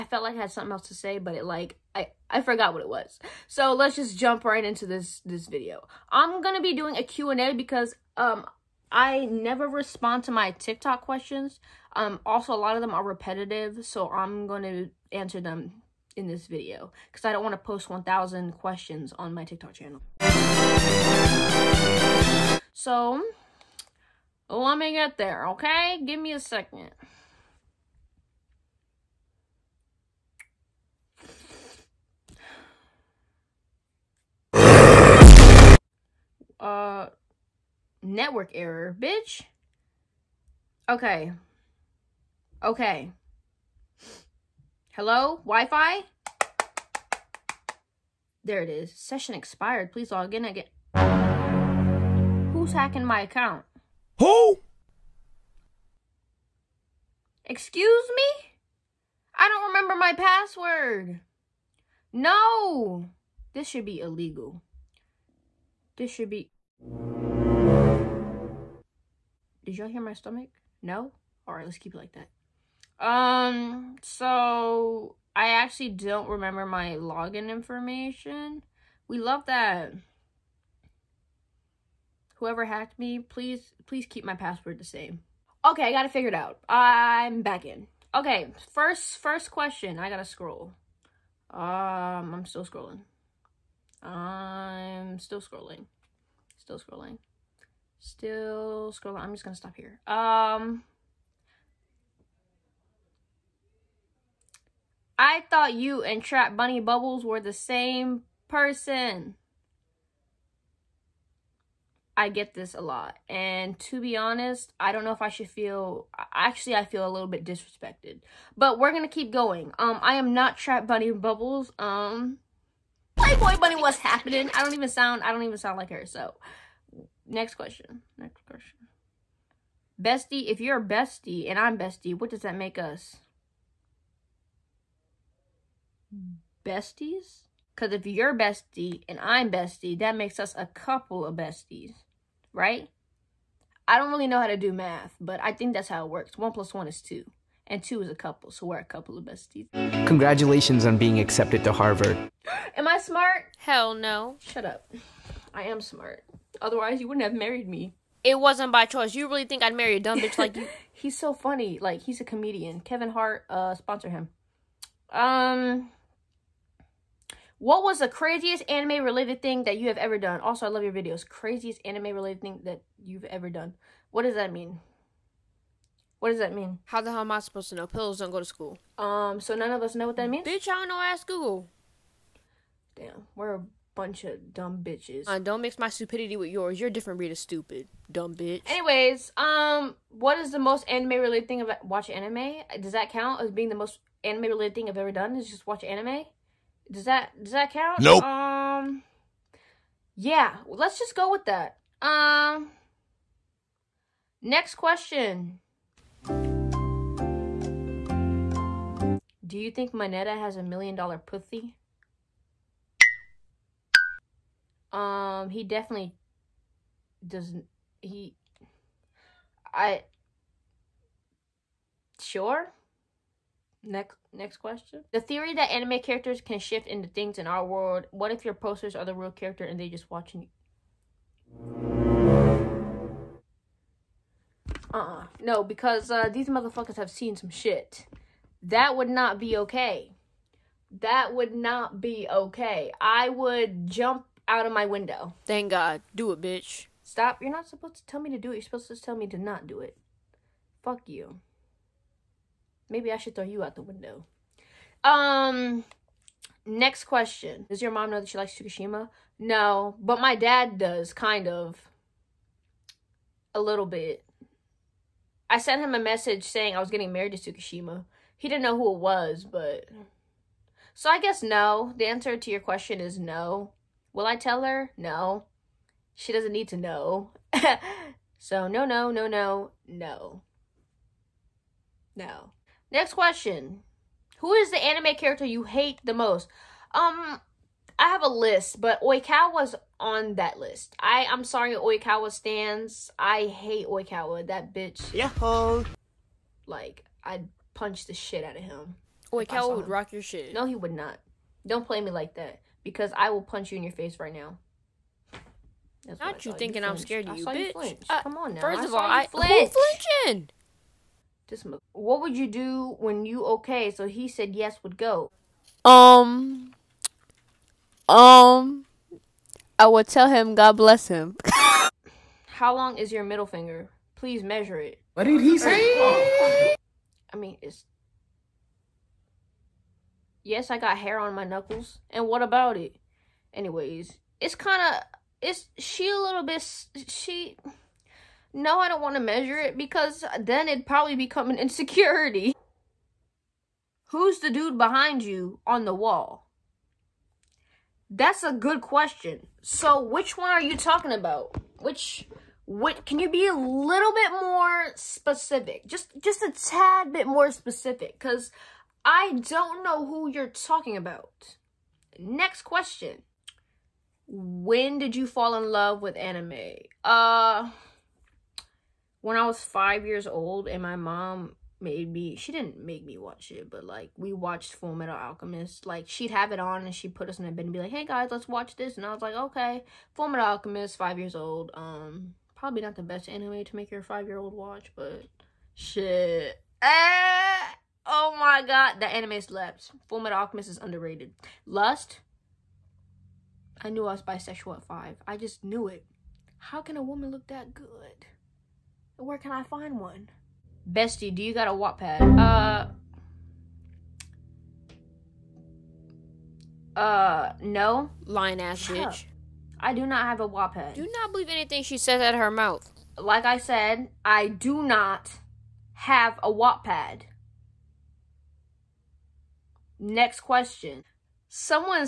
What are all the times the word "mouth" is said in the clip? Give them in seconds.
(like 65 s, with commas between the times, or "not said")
412 s.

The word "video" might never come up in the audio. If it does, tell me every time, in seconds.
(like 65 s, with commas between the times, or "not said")
5 s, 16 s, 170 s.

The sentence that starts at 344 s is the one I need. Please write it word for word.
Who's the dude behind you on the wall?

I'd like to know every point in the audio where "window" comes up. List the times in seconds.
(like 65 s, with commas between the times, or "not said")
244 s, 253 s.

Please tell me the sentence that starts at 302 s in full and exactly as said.
Because I will punch you in your face right now.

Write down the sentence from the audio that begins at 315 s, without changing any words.
Um, um, I would tell him God bless him.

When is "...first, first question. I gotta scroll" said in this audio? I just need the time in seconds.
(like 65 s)
88 s.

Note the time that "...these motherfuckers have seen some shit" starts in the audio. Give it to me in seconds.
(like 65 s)
236 s.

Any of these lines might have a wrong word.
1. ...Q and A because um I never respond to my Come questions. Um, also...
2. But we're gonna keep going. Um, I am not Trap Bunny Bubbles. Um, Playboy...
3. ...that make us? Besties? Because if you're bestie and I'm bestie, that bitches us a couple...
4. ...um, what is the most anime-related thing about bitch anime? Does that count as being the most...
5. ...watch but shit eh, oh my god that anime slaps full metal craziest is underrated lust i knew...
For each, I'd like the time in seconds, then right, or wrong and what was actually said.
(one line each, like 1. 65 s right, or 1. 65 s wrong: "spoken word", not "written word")
1. 7 s wrong: "TikTok", not "Come"
2. 118 s right
3. 132 s wrong: "makes", not "bitches"
4. 189 s wrong: "watch", not "bitch"
5. 384 s wrong: "alchemist", not "craziest".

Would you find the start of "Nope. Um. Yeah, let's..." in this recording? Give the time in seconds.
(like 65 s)
198 s.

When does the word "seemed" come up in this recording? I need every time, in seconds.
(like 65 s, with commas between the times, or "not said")
not said.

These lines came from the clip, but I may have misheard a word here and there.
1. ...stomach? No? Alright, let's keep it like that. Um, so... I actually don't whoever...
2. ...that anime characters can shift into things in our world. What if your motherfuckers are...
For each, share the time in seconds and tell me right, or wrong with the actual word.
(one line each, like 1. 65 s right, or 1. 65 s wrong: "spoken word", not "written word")
1. 70 s wrong: "remember", not "whoever"
2. 225 s wrong: "posters", not "motherfuckers".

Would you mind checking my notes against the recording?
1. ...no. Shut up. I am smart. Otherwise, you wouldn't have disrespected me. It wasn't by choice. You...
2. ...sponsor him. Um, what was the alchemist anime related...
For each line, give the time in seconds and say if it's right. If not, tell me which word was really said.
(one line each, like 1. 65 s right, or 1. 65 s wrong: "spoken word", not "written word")
1. 153 s wrong: "married", not "disrespected"
2. 163 s wrong: "craziest", not "alchemist".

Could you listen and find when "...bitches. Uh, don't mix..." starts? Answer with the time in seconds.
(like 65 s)
184 s.